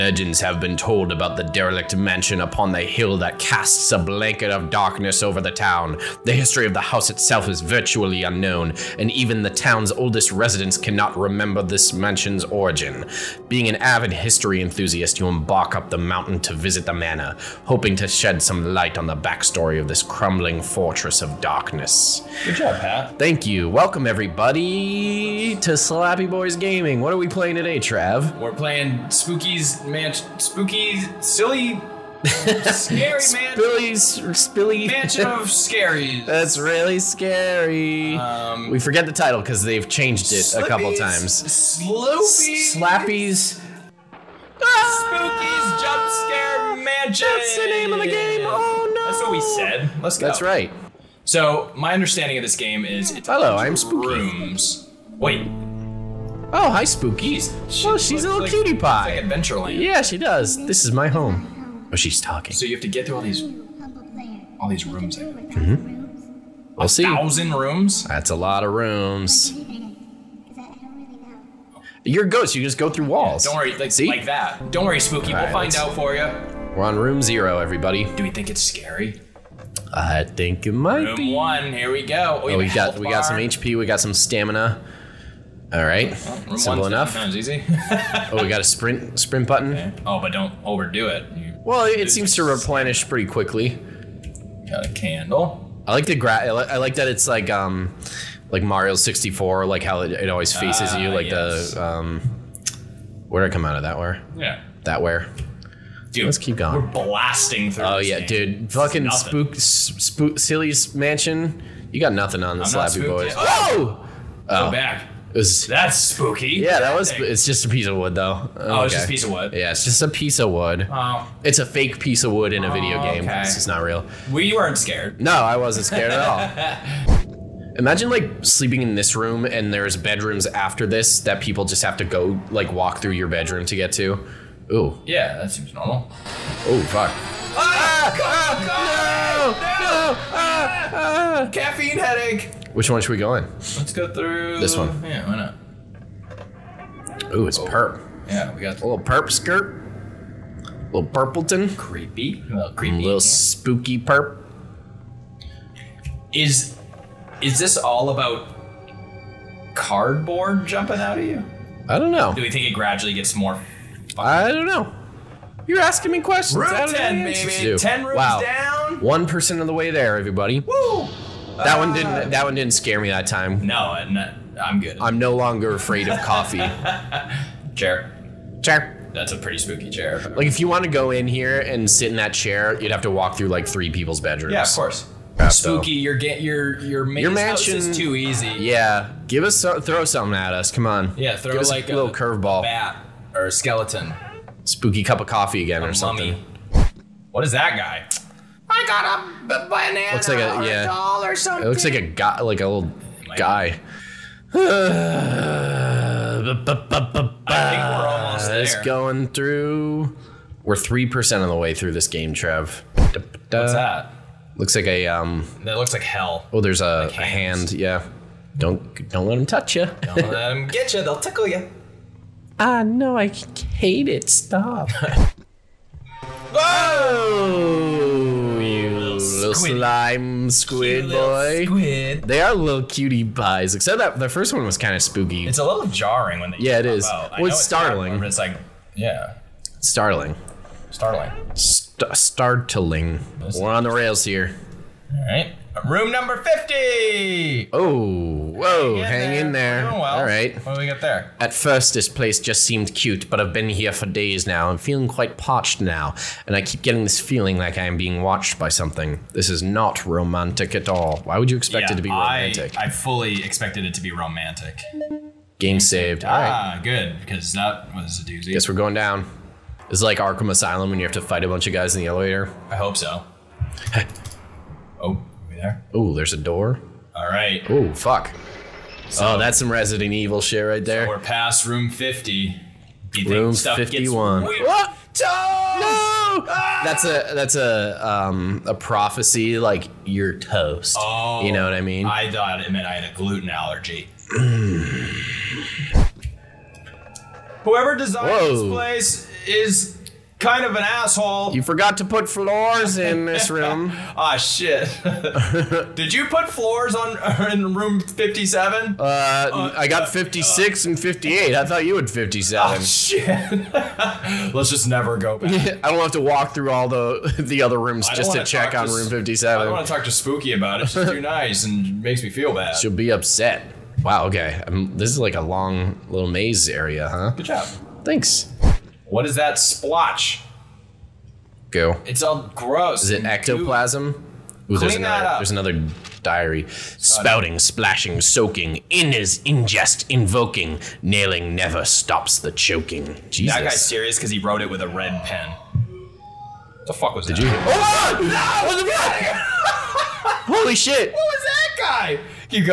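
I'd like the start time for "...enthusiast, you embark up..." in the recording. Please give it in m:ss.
0:14.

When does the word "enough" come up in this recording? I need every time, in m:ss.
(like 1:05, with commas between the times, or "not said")
1:26.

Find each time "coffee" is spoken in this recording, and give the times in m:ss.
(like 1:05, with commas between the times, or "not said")
2:56, 3:15.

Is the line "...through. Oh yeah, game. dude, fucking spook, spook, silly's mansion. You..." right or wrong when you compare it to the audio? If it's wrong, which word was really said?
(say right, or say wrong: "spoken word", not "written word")
right.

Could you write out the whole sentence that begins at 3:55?
It's a little jarring when they.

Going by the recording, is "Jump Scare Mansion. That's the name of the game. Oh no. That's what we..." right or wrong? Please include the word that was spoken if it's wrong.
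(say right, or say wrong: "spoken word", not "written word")
right.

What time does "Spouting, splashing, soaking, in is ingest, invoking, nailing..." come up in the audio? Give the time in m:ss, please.
5:36.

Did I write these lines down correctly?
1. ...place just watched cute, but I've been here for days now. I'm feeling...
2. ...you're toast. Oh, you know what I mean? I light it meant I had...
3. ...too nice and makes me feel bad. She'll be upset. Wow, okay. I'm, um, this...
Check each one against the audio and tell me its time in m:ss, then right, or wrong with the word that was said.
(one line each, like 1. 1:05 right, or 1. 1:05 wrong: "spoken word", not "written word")
1. 4:12 wrong: "seemed", not "watched"
2. 4:50 wrong: "thought", not "light"
3. 5:21 right.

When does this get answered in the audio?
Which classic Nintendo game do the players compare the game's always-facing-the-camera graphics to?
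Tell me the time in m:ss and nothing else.
1:38.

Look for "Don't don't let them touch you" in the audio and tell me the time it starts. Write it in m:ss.
3:38.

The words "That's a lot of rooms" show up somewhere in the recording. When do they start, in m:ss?
1:08.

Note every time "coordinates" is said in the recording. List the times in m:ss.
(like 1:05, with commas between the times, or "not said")
not said.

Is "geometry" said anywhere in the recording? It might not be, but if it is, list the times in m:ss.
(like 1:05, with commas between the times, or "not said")
not said.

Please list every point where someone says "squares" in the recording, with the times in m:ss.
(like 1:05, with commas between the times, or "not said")
not said.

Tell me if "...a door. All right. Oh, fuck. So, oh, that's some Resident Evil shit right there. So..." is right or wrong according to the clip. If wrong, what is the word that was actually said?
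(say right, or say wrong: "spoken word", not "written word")
right.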